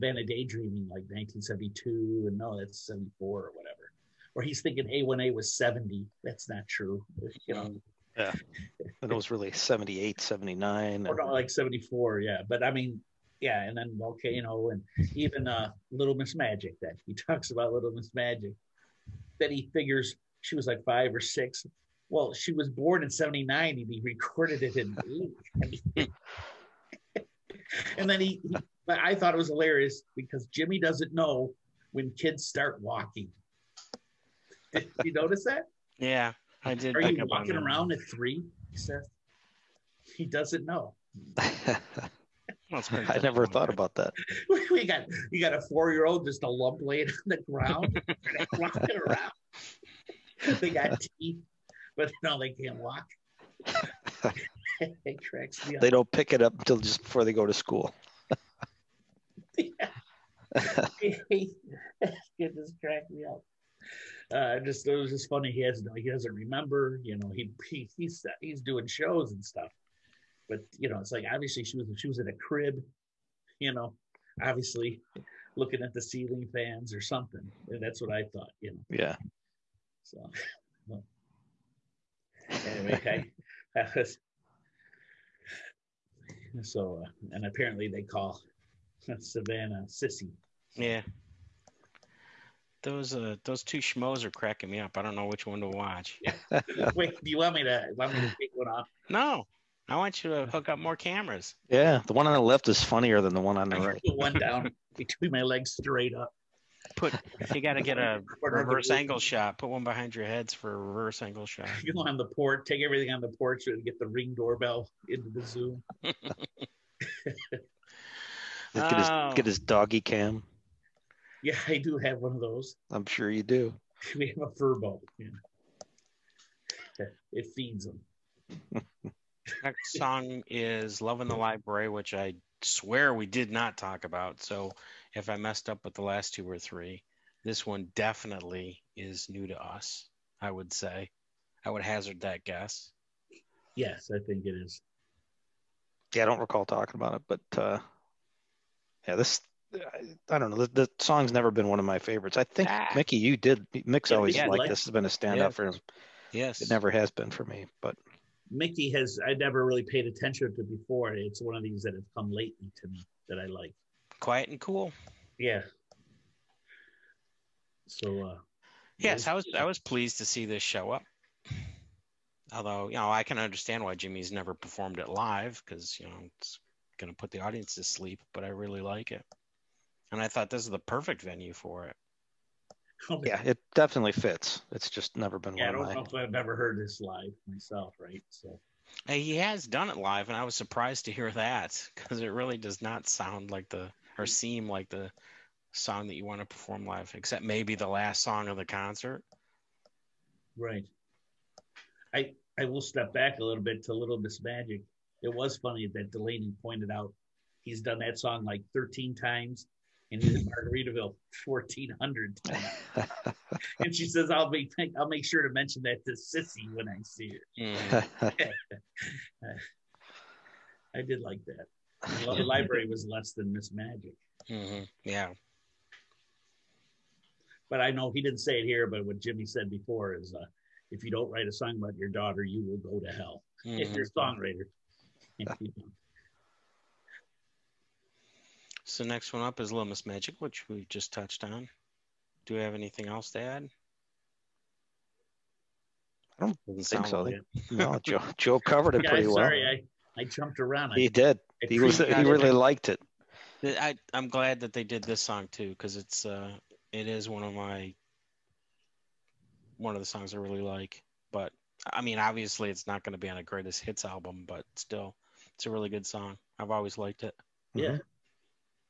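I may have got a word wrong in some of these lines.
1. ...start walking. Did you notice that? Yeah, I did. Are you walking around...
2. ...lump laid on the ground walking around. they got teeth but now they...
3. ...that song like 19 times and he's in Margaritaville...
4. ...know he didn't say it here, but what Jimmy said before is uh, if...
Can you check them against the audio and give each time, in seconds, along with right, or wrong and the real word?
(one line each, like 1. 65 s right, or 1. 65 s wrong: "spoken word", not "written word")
1. 32 s right
2. 46 s right
3. 207 s wrong: "13", not "19"
4. 227 s right.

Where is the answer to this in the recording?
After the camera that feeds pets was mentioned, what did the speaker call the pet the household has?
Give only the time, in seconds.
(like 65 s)
124 s.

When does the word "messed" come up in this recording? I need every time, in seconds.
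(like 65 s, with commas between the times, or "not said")
135 s.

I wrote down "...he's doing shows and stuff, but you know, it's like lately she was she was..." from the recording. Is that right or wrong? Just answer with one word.
wrong.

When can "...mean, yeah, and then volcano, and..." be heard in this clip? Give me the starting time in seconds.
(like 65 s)
12 s.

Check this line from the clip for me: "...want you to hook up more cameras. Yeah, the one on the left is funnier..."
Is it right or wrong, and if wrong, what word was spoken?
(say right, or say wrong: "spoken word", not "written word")
right.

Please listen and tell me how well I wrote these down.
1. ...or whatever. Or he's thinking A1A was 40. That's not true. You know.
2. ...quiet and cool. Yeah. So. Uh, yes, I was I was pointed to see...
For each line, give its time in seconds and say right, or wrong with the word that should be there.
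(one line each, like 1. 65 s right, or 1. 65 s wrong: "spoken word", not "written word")
1. 3 s wrong: "70", not "40"
2. 164 s wrong: "pleased", not "pointed".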